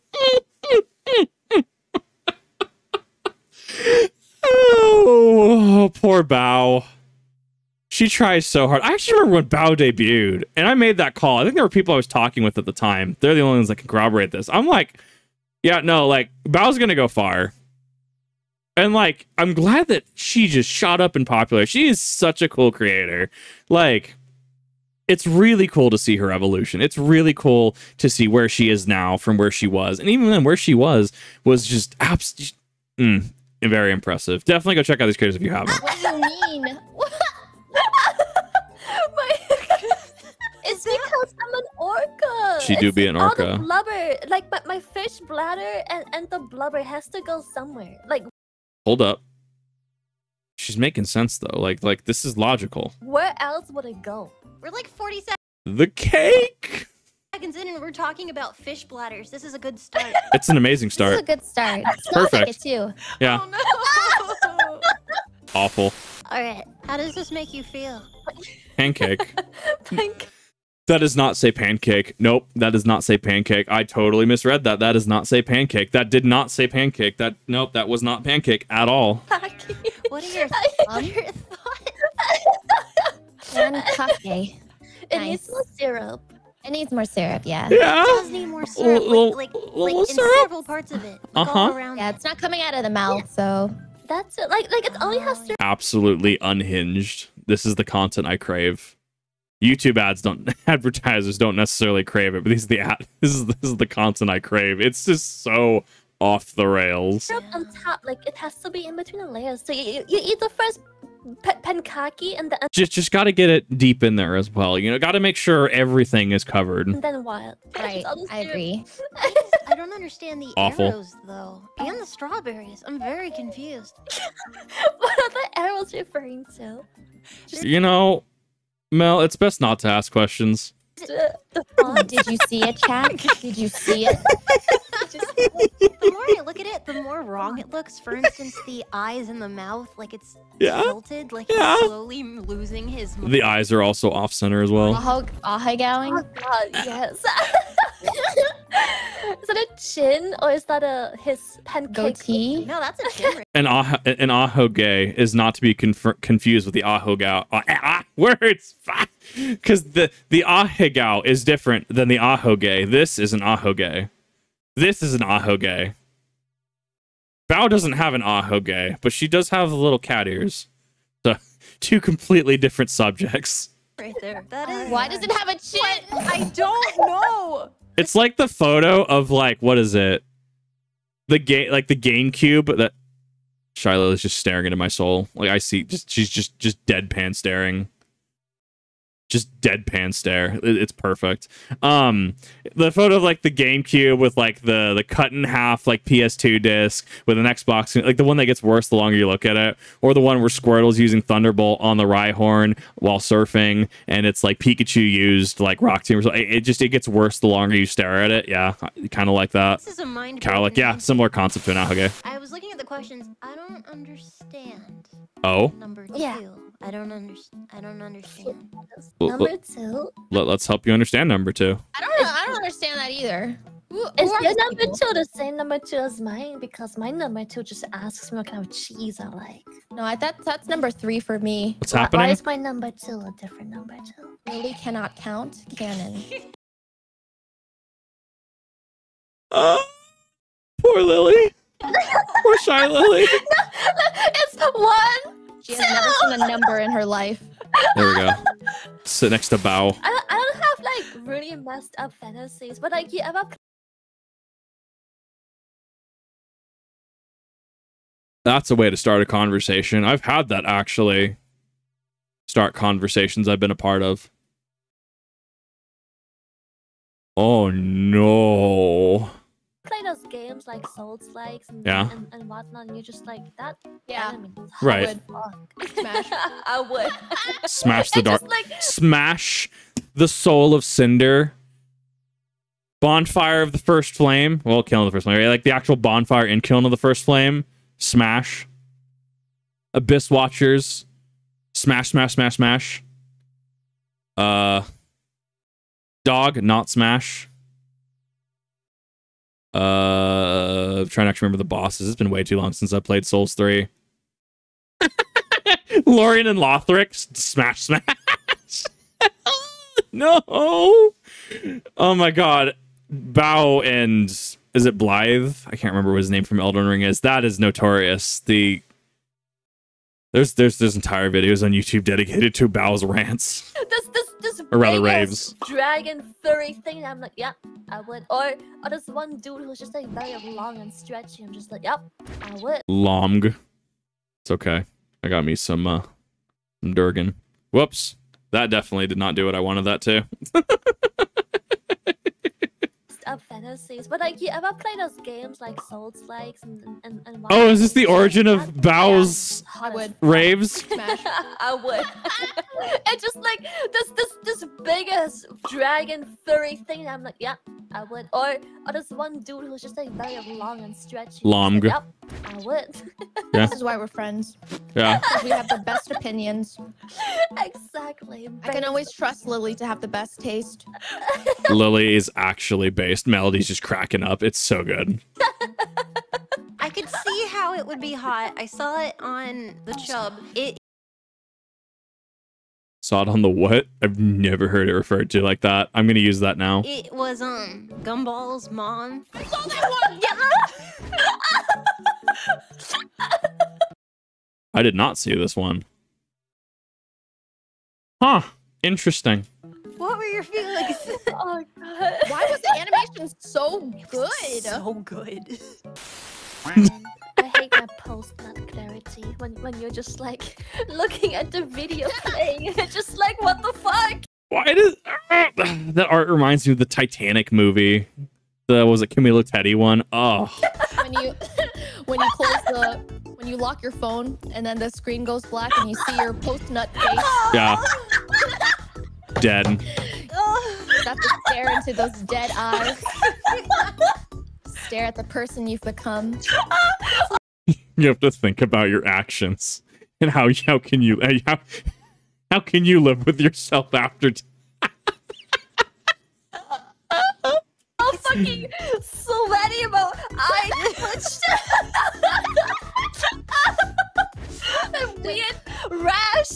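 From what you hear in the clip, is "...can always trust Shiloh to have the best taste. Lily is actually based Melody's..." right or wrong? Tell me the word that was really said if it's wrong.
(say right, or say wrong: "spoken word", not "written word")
wrong: "Lily", not "Shiloh".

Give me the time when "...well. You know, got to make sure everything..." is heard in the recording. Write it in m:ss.
1:54.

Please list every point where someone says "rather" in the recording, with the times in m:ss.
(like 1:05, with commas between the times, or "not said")
5:24.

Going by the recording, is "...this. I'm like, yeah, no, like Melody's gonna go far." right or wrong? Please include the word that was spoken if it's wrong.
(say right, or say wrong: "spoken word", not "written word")
wrong: "Bao", not "Melody".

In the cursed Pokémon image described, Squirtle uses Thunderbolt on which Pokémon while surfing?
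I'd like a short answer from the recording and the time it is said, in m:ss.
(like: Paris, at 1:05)
Rhyhorn, at 3:22.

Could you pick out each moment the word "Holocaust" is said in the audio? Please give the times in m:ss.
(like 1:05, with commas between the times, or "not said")
not said.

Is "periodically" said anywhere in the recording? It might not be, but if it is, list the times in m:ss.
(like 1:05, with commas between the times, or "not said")
not said.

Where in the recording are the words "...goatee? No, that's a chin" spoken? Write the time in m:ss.
2:31.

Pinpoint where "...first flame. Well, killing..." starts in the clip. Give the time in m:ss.
4:43.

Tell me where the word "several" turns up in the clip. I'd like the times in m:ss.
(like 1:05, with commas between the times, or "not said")
1:30.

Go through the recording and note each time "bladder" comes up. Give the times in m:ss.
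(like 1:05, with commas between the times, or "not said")
0:45, 0:58.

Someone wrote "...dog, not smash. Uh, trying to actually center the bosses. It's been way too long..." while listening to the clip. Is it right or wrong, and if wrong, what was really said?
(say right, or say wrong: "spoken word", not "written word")
wrong: "remember", not "center".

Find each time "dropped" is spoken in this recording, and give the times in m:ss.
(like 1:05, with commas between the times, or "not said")
not said.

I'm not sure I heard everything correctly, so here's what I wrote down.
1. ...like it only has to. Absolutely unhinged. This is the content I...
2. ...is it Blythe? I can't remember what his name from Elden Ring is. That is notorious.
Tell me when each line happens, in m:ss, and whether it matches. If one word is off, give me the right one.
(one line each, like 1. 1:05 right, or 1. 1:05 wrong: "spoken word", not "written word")
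1. 1:34 right
2. 5:14 right.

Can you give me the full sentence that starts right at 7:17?
You have to think about your actions and how how can you eh, how, how can you live with yourself after death?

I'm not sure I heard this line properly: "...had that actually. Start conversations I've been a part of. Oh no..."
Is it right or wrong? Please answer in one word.
right.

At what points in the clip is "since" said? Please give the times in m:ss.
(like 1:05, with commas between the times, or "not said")
5:02.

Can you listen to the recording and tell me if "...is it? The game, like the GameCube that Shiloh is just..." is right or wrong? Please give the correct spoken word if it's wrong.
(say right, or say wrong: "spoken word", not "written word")
right.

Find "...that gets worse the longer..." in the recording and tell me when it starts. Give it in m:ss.
3:18.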